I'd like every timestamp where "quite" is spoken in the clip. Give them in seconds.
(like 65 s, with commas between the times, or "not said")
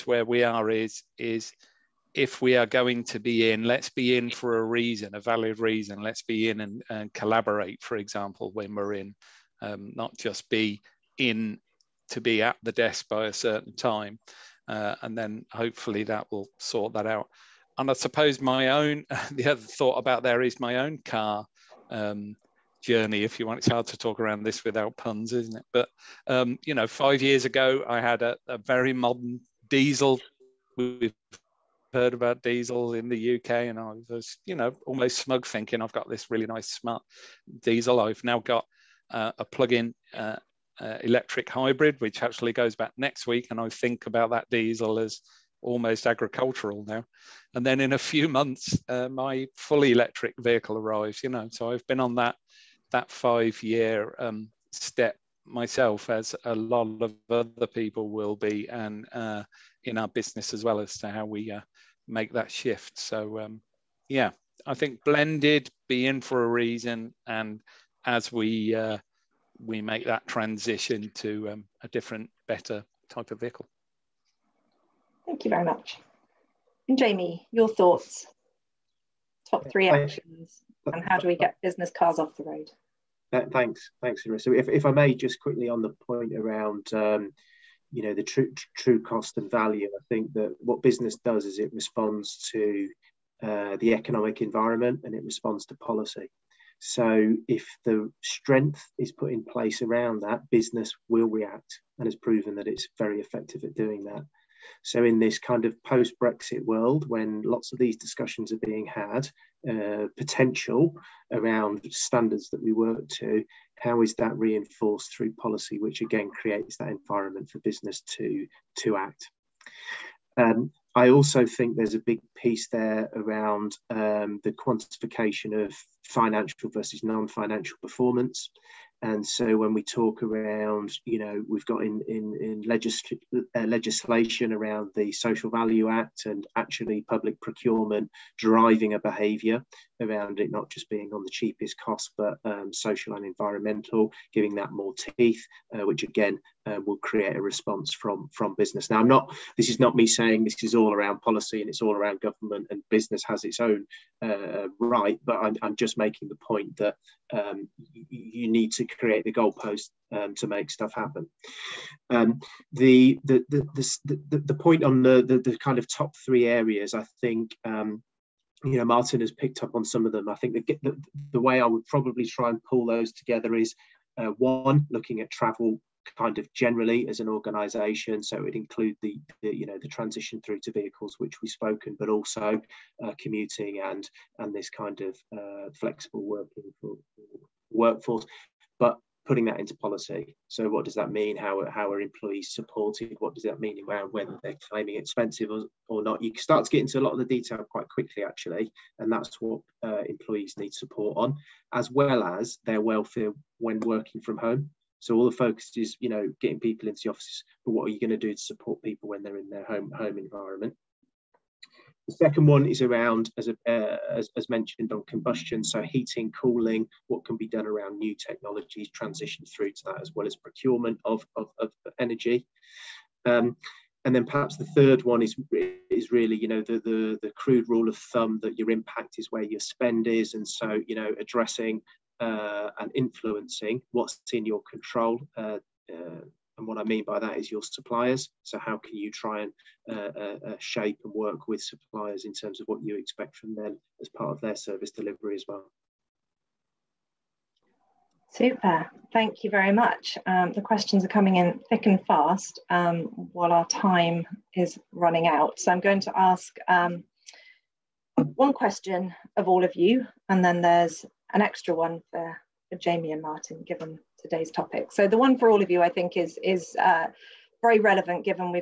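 197 s.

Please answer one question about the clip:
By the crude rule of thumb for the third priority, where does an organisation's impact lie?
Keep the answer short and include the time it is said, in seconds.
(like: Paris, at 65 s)
your spend, at 229 s.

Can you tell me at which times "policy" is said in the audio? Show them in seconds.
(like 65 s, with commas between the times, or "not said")
95 s, 115 s, 151 s, 189 s.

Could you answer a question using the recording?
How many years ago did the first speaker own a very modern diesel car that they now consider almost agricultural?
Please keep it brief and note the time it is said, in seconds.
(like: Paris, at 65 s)
5, at 26 s.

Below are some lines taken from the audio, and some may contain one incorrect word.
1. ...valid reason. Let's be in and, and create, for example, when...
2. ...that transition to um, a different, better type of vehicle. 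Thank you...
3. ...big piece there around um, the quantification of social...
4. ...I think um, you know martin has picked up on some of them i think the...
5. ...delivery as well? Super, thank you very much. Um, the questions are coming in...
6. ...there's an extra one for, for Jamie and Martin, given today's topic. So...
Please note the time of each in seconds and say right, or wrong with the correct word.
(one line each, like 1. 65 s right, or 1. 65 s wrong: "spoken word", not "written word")
1. 5 s wrong: "collaborate", not "create"
2. 70 s right
3. 121 s wrong: "financial", not "social"
4. 166 s right
5. 244 s right
6. 260 s right.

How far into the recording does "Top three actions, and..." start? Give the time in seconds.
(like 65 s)
79 s.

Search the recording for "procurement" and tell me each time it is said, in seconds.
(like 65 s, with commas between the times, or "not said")
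137 s, 220 s.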